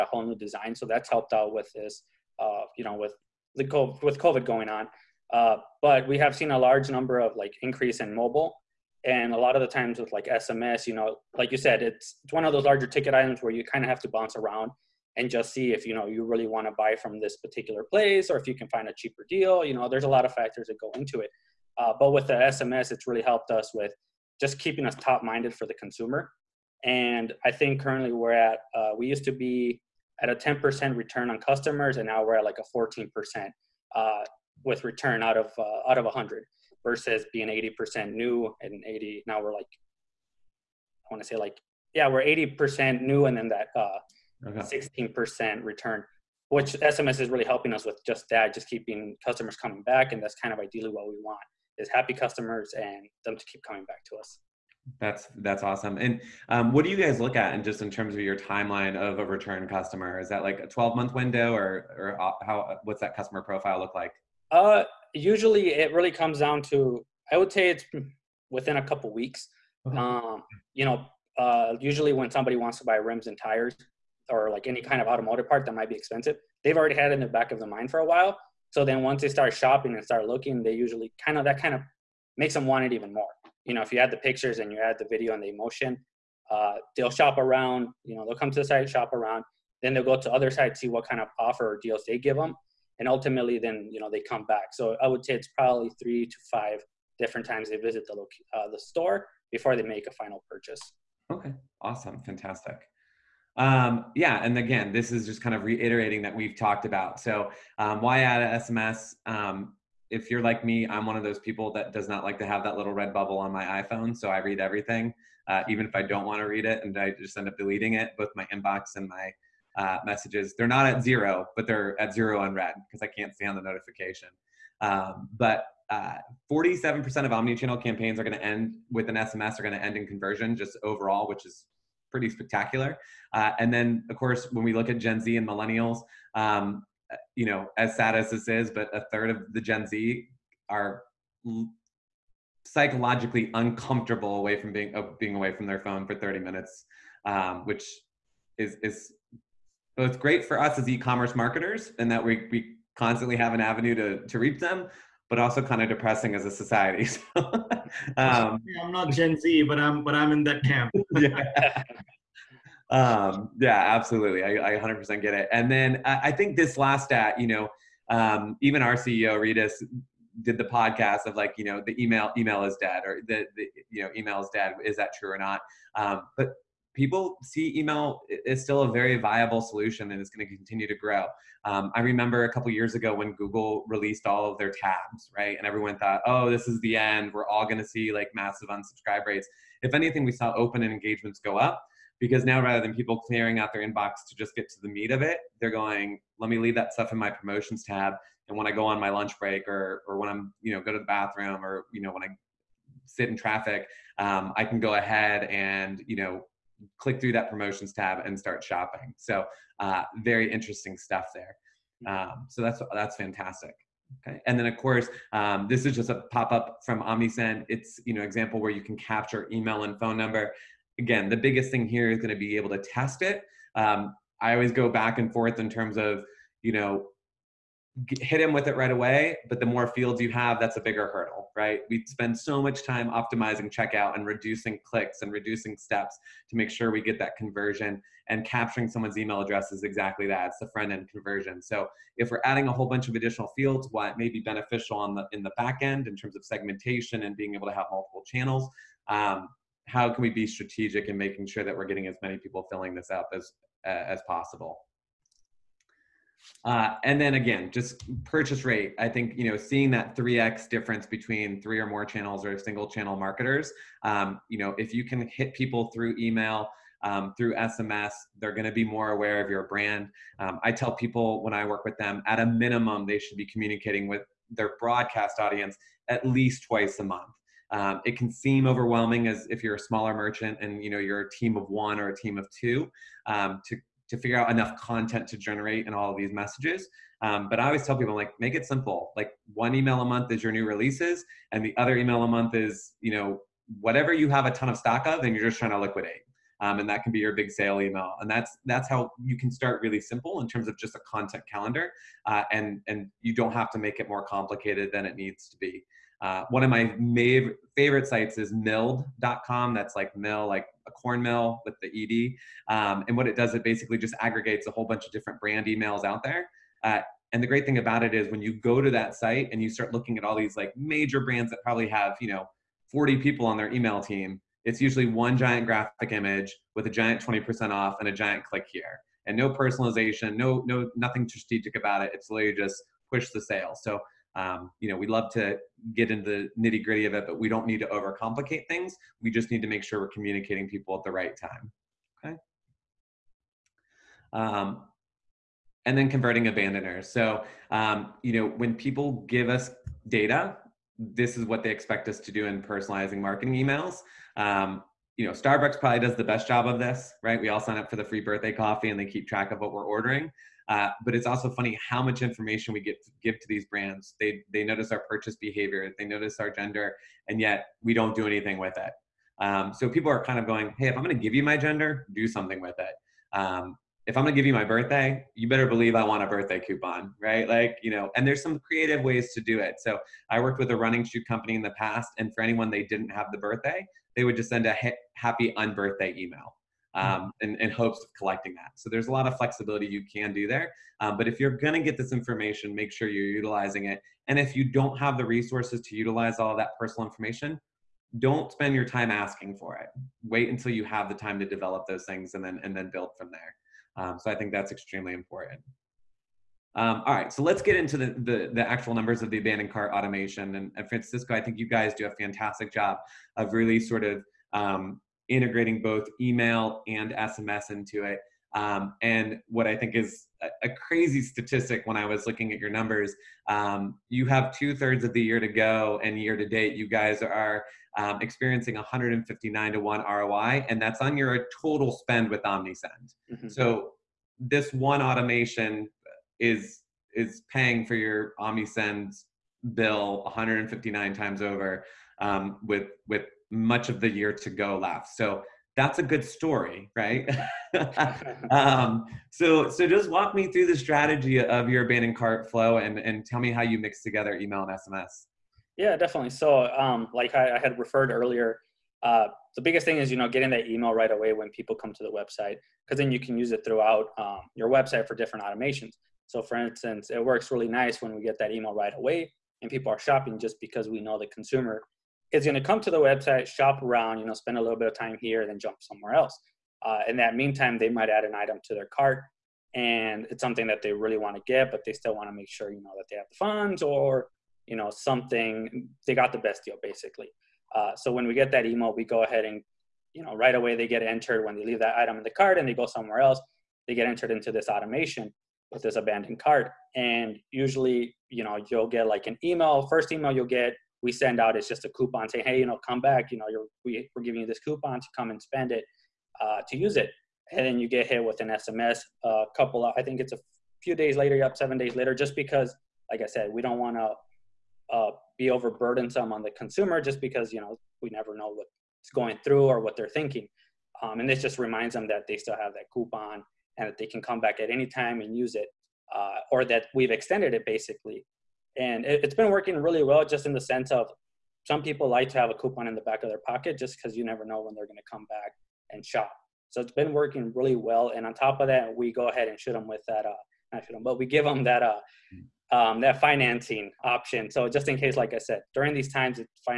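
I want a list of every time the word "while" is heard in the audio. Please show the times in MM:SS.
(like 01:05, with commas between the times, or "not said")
01:18.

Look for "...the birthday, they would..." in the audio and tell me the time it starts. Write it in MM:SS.
06:23.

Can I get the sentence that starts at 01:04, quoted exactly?
Uh, usually it really comes down to I would say it's within a couple weeks.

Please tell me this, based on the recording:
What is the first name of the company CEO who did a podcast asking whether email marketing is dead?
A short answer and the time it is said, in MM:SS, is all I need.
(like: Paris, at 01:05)
Rytis, at 02:49.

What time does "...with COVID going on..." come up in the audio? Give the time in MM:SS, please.
00:04.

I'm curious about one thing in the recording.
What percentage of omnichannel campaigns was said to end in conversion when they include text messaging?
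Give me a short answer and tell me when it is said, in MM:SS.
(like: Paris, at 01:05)
47%, at 02:06.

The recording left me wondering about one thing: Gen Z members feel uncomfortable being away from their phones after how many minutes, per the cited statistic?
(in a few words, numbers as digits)
30 minutes.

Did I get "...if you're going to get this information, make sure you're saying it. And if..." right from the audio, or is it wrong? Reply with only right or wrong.
wrong.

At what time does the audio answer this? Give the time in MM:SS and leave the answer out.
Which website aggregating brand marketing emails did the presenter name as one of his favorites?
05:08.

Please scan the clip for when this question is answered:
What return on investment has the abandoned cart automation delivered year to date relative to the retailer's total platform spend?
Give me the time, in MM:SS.
07:08.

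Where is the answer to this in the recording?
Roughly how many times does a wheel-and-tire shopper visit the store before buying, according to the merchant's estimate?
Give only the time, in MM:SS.
01:36.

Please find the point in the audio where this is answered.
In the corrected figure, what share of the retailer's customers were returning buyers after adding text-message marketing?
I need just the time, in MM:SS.
00:44.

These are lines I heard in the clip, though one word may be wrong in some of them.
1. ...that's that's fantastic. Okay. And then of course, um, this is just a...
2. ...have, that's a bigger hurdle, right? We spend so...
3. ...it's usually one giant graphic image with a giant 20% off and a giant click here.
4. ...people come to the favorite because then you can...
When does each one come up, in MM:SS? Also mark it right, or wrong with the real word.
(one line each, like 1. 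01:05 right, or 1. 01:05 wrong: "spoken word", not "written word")
1. 03:32 right
2. 03:50 right
3. 05:24 right
4. 07:41 wrong: "website", not "favorite".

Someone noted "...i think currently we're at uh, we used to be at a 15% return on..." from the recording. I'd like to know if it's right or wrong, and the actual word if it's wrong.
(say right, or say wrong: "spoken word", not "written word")
wrong: "10", not "15".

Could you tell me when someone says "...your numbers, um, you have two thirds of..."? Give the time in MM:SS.
07:02.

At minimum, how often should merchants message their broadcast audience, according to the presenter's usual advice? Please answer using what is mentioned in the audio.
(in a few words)
twice a month.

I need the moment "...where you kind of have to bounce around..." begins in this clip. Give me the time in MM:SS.
00:13.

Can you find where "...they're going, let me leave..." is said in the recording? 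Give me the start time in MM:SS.
03:15.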